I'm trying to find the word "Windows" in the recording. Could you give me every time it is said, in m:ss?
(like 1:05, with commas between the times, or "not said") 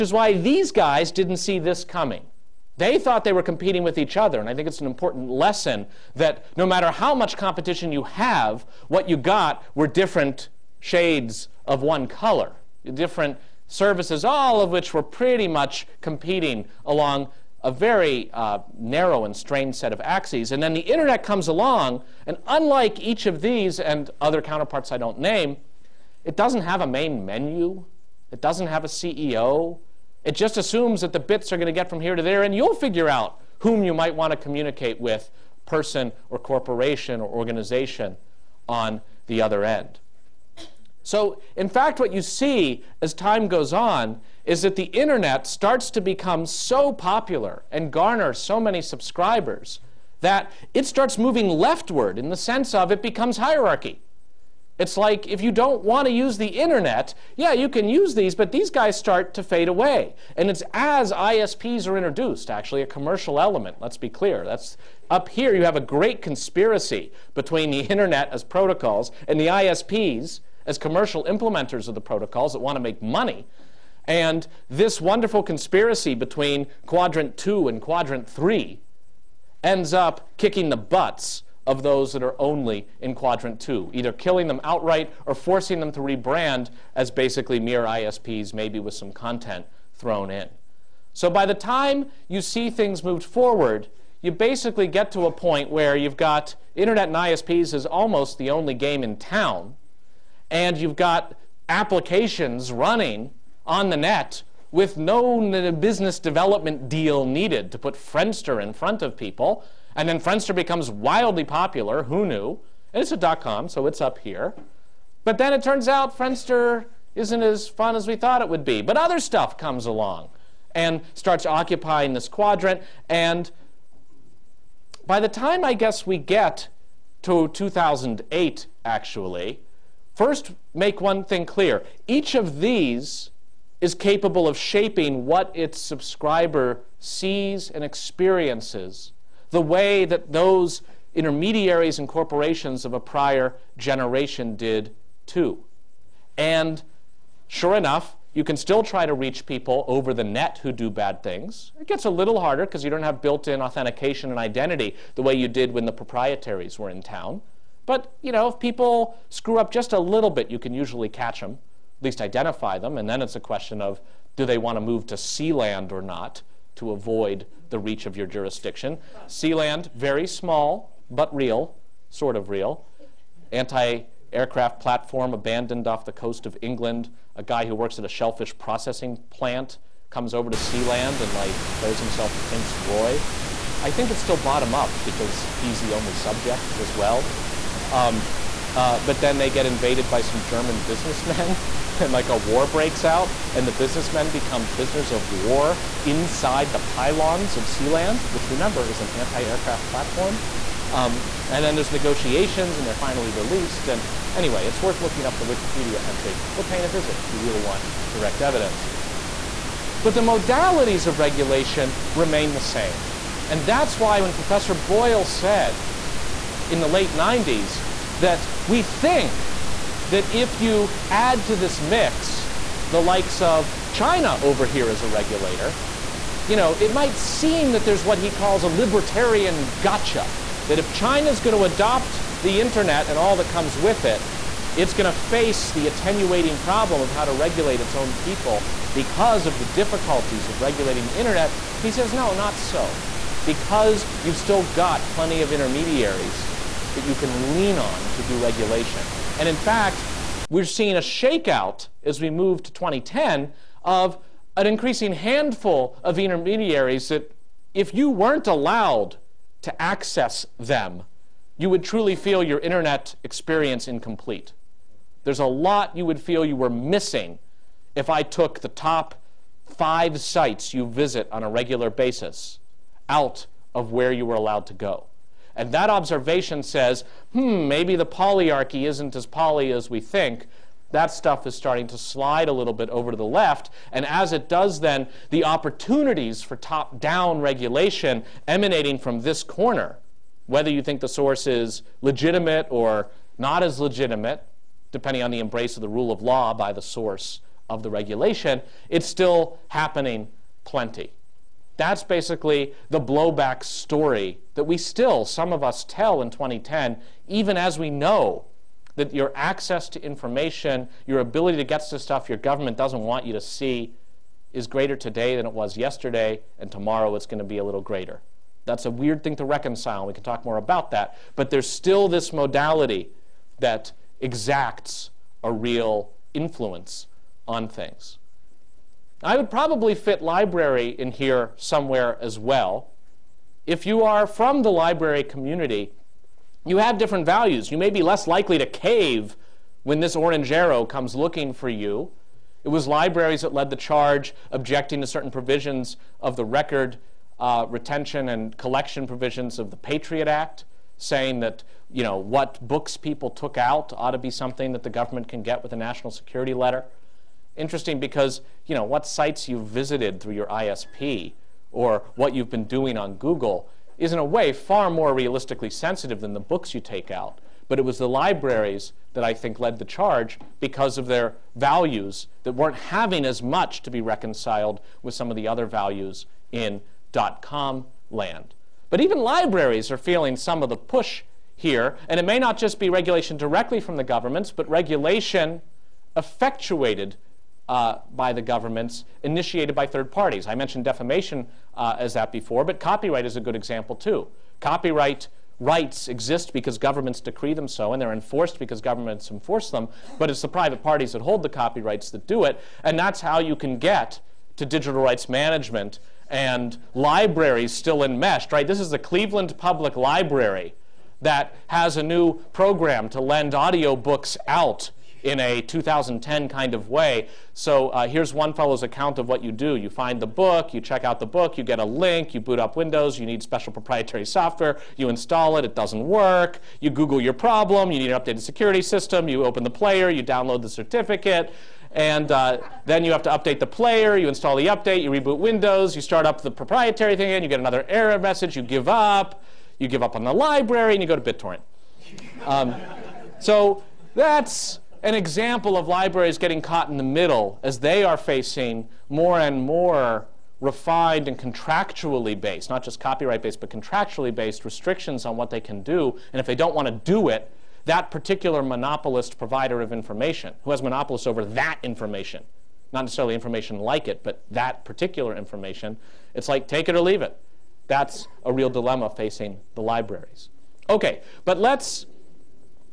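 7:02, 7:15.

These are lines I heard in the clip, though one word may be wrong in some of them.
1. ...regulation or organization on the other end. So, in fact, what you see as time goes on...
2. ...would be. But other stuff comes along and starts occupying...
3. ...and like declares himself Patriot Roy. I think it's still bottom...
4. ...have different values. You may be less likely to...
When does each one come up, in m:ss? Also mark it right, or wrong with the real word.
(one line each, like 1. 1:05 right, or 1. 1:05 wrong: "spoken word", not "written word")
1. 0:36 wrong: "corporation", not "regulation"
2. 1:58 right
3. 3:01 wrong: "Prince", not "Patriot"
4. 5:36 right.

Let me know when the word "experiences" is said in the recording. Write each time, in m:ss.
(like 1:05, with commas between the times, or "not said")
2:17, 4:23.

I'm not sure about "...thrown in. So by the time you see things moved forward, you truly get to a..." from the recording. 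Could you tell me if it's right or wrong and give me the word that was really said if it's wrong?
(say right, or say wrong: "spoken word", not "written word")
wrong: "basically", not "truly".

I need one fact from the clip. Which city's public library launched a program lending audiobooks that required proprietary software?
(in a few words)
Cleveland.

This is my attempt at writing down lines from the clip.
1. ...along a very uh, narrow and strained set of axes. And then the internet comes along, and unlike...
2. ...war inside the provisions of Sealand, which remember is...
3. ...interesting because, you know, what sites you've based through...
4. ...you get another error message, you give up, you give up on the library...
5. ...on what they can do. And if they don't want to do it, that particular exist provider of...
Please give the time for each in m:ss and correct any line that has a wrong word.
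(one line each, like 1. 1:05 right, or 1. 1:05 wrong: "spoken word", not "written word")
1. 0:16 right
2. 3:15 wrong: "pylons", not "provisions"
3. 5:57 wrong: "visited", not "based"
4. 7:17 right
5. 7:35 wrong: "monopolist", not "exist".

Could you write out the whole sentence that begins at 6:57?
So uh, here's one fellow's account of what you do.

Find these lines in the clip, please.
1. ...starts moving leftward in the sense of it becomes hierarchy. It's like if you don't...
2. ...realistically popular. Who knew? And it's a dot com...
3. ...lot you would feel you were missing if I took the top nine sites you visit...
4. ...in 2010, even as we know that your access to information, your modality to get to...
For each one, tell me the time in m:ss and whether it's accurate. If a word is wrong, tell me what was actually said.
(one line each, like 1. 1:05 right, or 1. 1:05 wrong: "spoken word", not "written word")
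1. 0:50 right
2. 1:50 wrong: "wildly", not "realistically"
3. 4:25 wrong: "five", not "nine"
4. 5:06 wrong: "ability", not "modality".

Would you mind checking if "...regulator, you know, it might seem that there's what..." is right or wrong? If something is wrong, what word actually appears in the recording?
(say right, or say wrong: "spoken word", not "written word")
right.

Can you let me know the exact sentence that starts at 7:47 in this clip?
That's a real dilemma facing the libraries.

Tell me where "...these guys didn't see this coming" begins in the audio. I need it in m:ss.
0:00.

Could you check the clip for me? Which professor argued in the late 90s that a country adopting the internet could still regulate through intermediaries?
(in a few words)
Professor Boyle.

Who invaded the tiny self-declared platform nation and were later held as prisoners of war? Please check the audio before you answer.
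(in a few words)
German businessmen.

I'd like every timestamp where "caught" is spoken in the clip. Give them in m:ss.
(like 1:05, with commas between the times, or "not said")
7:26.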